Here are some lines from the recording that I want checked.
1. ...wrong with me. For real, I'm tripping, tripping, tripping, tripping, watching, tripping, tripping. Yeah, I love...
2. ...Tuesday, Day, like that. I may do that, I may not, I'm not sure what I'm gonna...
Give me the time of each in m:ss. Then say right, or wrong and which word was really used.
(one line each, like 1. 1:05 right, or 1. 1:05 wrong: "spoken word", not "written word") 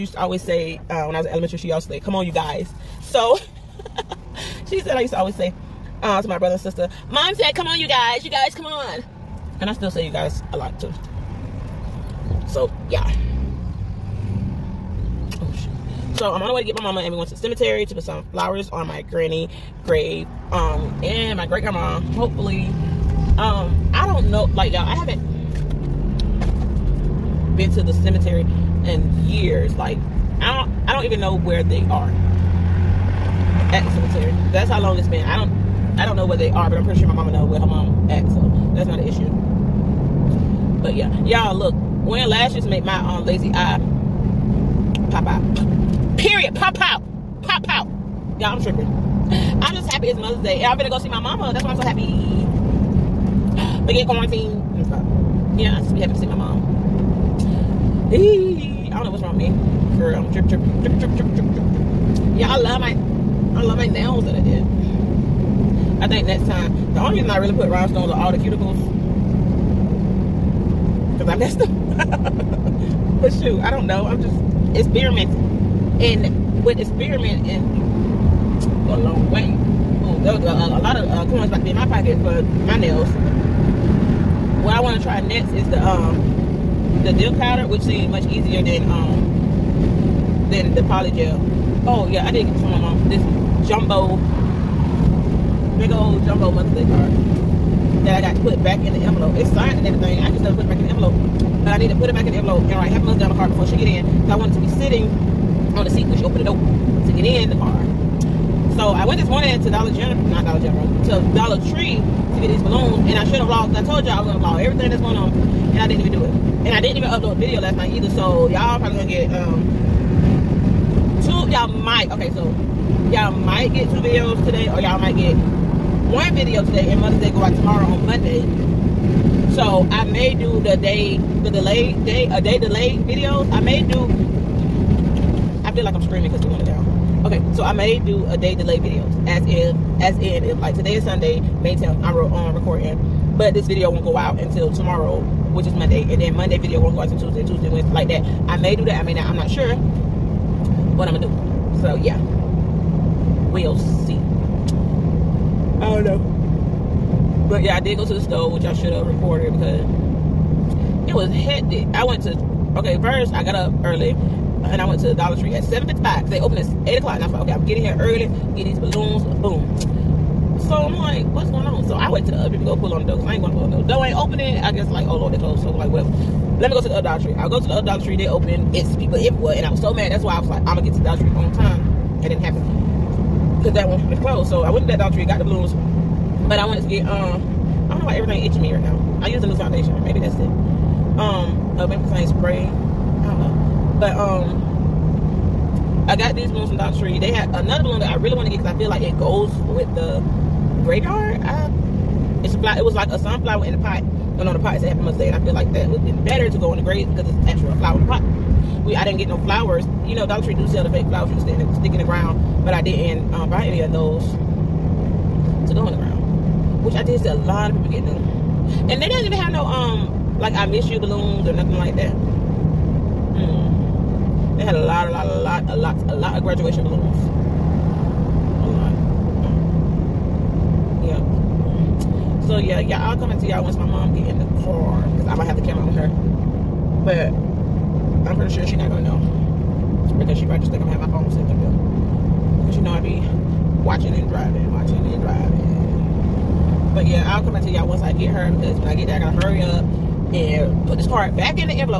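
1. 0:59 wrong: "tripping", not "watching"
2. 2:27 wrong: "Wednesday", not "Day".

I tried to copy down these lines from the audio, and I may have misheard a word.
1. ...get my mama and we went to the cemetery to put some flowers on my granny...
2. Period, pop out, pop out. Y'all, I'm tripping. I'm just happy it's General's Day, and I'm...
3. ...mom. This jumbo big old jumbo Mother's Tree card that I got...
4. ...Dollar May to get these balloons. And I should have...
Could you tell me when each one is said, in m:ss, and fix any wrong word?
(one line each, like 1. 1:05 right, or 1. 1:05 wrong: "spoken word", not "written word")
1. 0:16 right
2. 0:46 wrong: "Mother", not "General"
3. 1:32 wrong: "Day", not "Tree"
4. 1:51 wrong: "Tree", not "May".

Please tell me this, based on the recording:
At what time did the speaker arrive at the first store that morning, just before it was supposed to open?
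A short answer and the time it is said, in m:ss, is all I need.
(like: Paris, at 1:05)
7:55, at 2:45.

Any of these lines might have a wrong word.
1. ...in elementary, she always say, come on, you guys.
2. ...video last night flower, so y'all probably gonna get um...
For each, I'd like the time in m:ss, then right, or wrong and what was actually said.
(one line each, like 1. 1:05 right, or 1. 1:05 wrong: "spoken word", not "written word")
1. 0:01 right
2. 1:57 wrong: "either", not "flower".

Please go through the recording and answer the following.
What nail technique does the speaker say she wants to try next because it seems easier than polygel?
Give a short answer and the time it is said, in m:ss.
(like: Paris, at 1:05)
dip powder, at 1:27.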